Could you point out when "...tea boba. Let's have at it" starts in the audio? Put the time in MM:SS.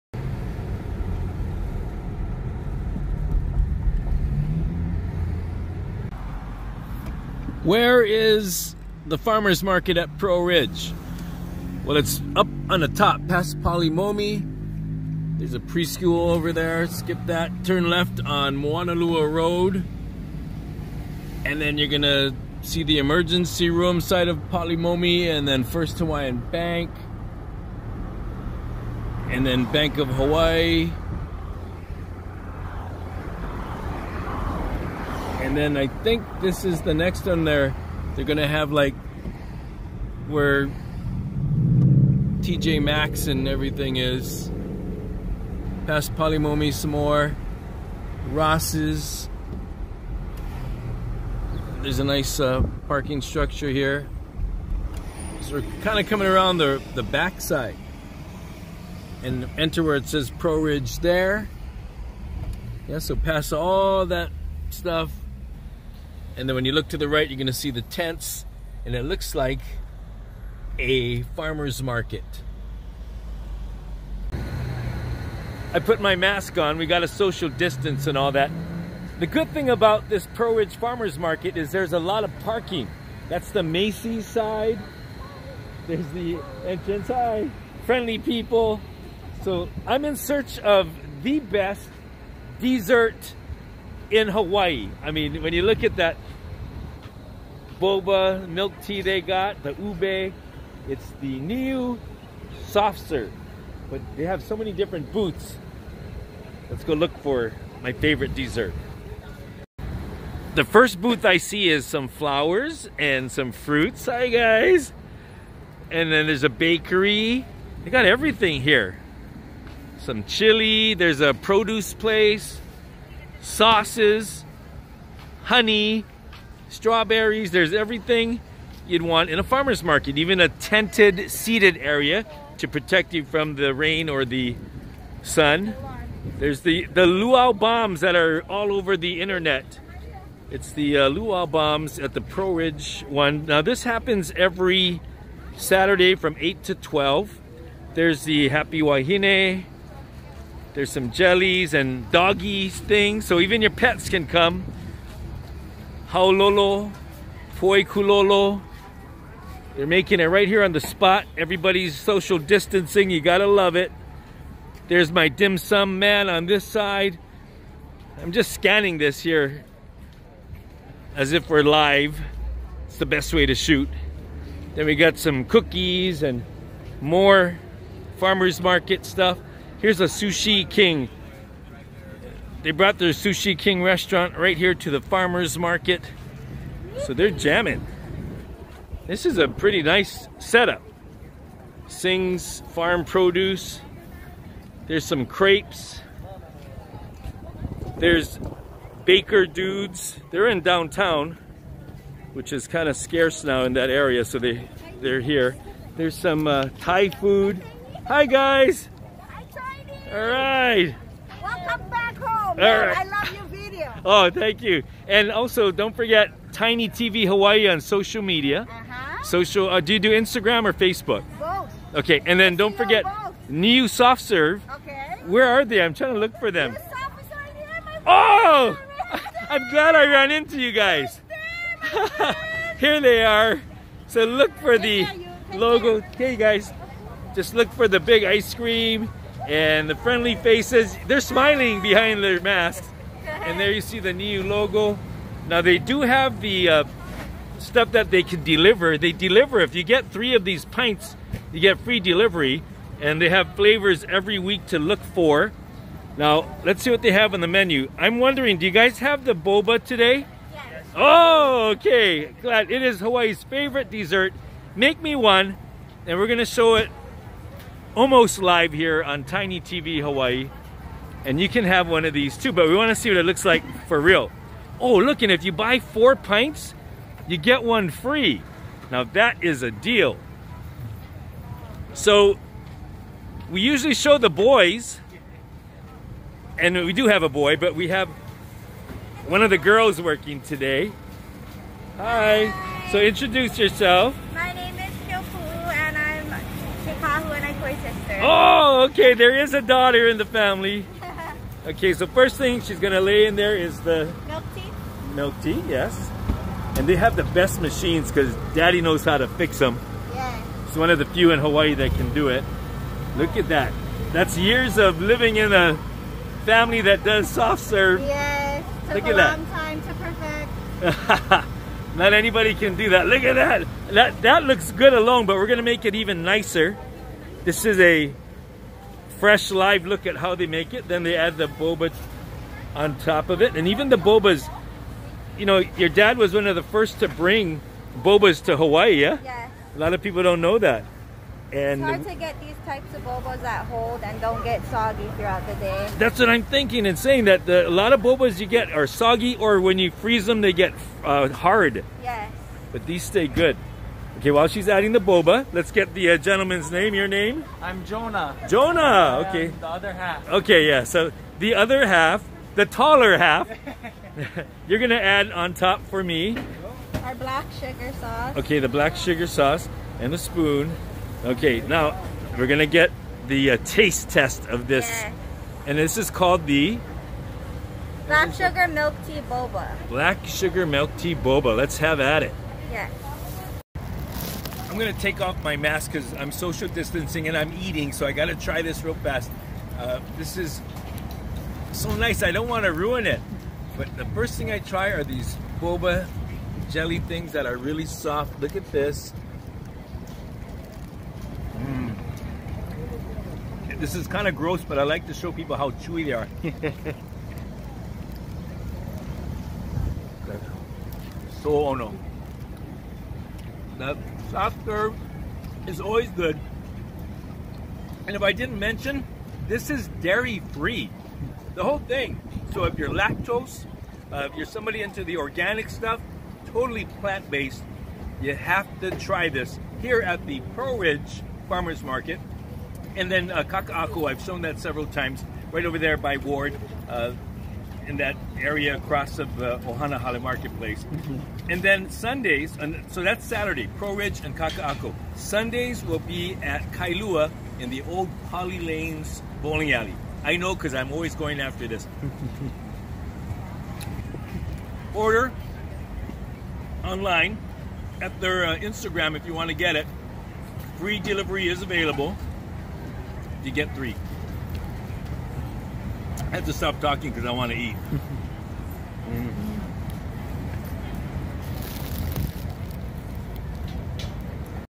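06:20.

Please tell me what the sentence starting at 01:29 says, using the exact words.
So I'm in search of the best dessert in Hawaii.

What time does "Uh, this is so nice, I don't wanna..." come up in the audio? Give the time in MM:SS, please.
06:29.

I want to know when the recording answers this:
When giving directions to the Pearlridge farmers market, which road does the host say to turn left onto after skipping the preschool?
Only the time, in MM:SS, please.
00:18.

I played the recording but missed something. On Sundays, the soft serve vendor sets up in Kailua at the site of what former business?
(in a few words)
Pali Lanes bowling alley.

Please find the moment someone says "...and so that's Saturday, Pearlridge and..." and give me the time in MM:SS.
07:22.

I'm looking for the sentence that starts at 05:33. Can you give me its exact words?
And even the bobas, you know, your dad was one of the first to bring bobas to Hawaii, yeah?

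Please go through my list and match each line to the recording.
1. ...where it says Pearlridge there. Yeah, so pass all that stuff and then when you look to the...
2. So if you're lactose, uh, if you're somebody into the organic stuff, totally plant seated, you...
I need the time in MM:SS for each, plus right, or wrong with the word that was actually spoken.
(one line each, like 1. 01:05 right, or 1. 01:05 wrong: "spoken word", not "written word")
1. 00:59 right
2. 07:02 wrong: "based", not "seated".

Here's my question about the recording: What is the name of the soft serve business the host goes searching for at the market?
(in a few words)
Niu Soft Serve.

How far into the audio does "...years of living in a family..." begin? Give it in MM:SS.
05:14.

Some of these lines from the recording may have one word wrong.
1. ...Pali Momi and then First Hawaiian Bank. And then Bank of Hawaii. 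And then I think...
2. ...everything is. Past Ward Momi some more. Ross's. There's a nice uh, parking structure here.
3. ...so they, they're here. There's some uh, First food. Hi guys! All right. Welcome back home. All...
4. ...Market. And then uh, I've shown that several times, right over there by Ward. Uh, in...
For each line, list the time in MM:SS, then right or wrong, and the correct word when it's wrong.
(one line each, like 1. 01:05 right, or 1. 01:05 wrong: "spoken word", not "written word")
1. 00:24 right
2. 00:43 wrong: "Pali", not "Ward"
3. 03:24 wrong: "Thai", not "First"
4. 07:11 right.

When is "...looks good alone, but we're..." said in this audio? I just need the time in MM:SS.
05:24.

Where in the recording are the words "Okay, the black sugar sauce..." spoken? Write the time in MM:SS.
06:08.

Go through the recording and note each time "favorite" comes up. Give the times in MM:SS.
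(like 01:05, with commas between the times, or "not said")
01:47, 04:23.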